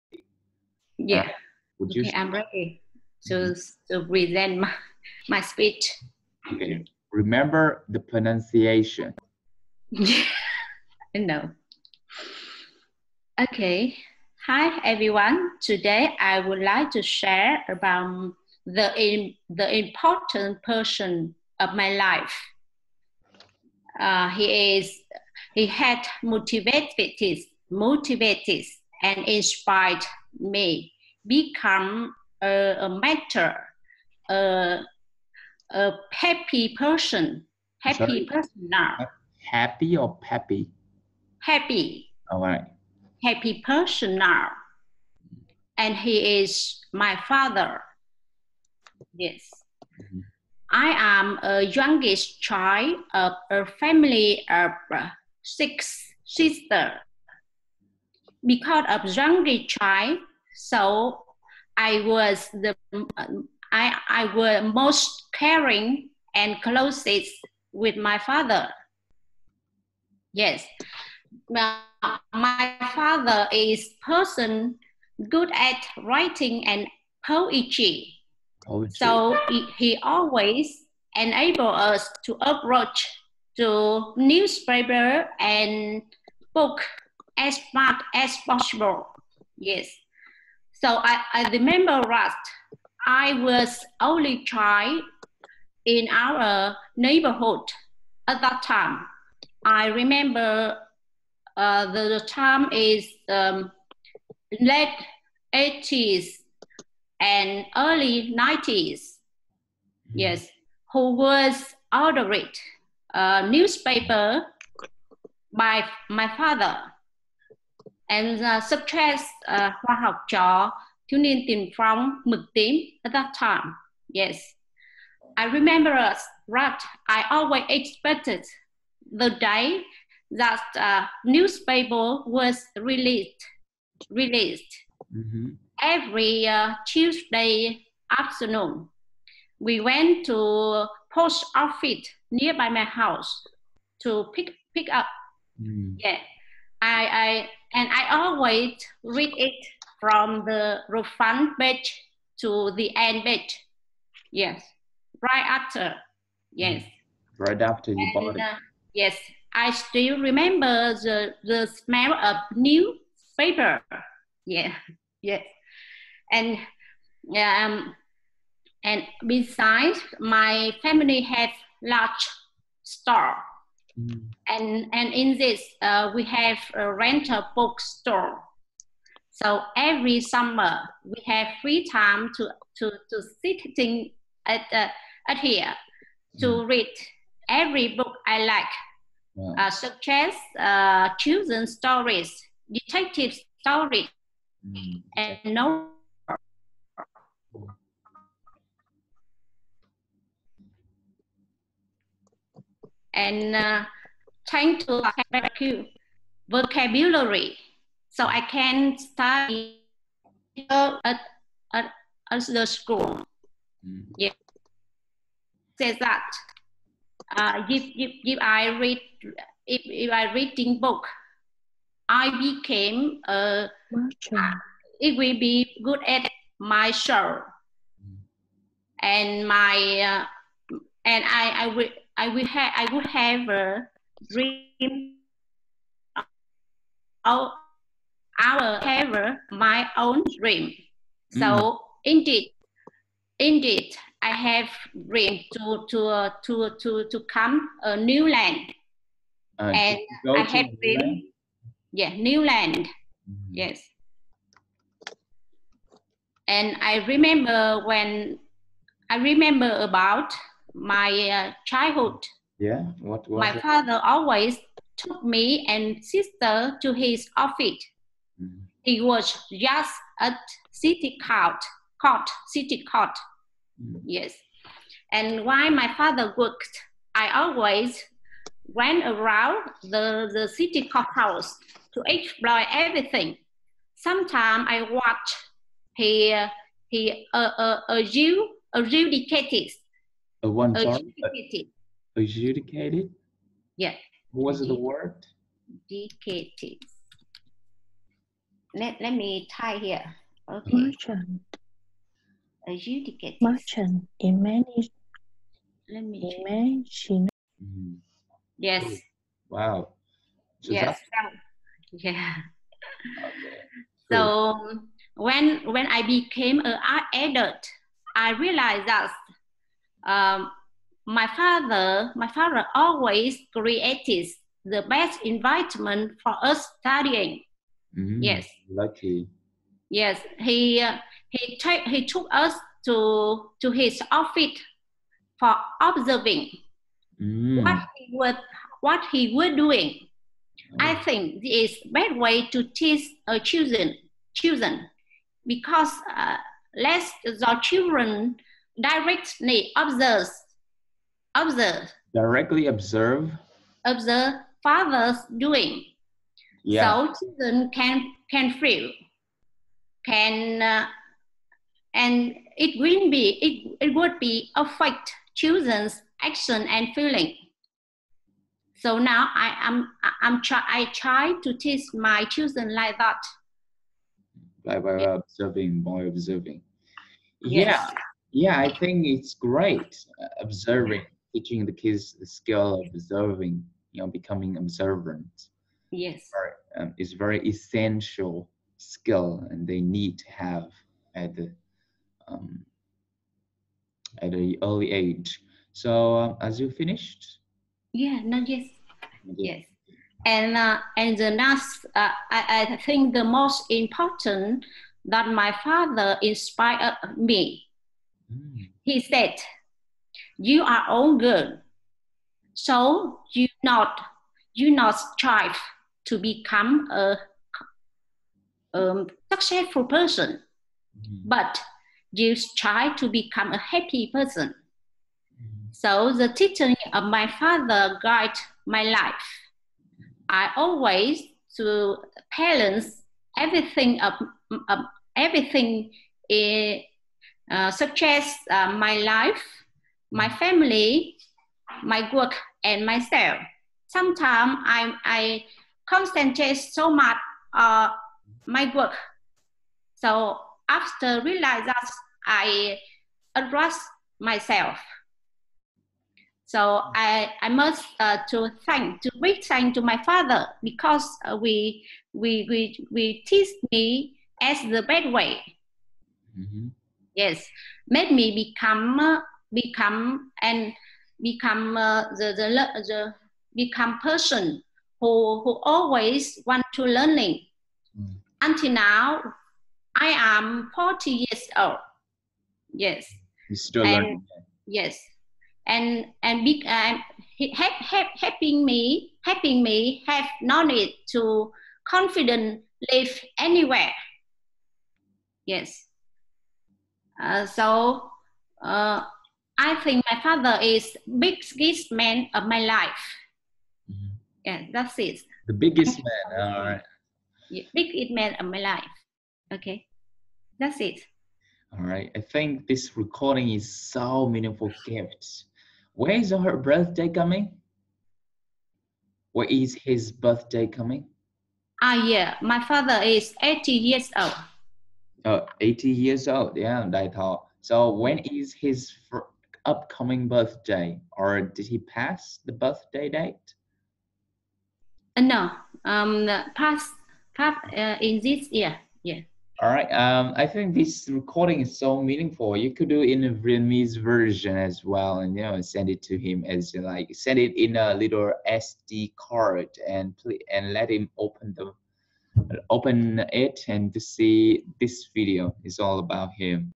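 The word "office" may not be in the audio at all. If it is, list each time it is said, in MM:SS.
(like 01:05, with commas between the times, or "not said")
02:21, 04:27, 05:34.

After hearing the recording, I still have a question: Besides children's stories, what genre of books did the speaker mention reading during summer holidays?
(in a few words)
Detective stories.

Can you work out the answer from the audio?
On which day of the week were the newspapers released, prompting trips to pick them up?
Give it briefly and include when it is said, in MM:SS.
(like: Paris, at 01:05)
Tuesday, at 02:16.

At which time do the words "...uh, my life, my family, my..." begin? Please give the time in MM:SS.
07:18.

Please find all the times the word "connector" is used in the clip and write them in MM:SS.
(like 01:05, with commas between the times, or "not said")
not said.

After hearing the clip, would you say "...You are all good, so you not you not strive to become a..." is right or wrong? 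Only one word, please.
right.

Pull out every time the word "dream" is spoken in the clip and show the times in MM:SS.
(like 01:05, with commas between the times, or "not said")
03:54, 04:00, 04:05, 04:10.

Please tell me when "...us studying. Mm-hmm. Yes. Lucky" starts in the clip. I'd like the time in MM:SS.
05:26.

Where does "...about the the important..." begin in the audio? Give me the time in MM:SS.
00:17.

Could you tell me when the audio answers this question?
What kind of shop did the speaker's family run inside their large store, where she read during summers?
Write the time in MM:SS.
02:56.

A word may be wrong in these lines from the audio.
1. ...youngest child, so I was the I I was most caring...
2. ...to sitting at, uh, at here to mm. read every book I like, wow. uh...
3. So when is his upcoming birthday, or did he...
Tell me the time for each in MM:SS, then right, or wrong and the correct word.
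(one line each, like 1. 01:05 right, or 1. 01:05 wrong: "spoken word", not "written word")
1. 00:59 right
2. 03:03 right
3. 08:47 right.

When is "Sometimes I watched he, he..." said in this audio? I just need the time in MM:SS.
04:43.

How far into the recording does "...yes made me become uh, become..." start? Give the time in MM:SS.
07:47.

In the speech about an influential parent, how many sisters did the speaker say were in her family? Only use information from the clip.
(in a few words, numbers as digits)
6.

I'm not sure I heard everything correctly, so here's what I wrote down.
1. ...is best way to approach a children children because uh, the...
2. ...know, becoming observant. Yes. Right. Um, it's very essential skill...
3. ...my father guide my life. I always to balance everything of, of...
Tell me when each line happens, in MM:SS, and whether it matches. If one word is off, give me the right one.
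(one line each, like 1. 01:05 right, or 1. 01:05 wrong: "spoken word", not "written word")
1. 05:41 wrong: "teach", not "approach"
2. 06:24 right
3. 07:07 right.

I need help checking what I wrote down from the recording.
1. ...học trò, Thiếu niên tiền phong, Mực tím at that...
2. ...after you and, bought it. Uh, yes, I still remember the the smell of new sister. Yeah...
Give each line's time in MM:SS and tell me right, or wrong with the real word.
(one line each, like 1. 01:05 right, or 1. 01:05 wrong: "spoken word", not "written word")
1. 02:00 right
2. 02:37 wrong: "paper", not "sister".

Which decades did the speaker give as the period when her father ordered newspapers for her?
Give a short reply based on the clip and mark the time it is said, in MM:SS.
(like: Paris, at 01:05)
Late 80s and early 90s, at 01:44.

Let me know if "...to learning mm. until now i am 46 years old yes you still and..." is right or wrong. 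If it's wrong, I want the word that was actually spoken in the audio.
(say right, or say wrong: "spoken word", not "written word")
wrong: "40", not "46".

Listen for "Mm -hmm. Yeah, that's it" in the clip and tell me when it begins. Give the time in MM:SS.
08:23.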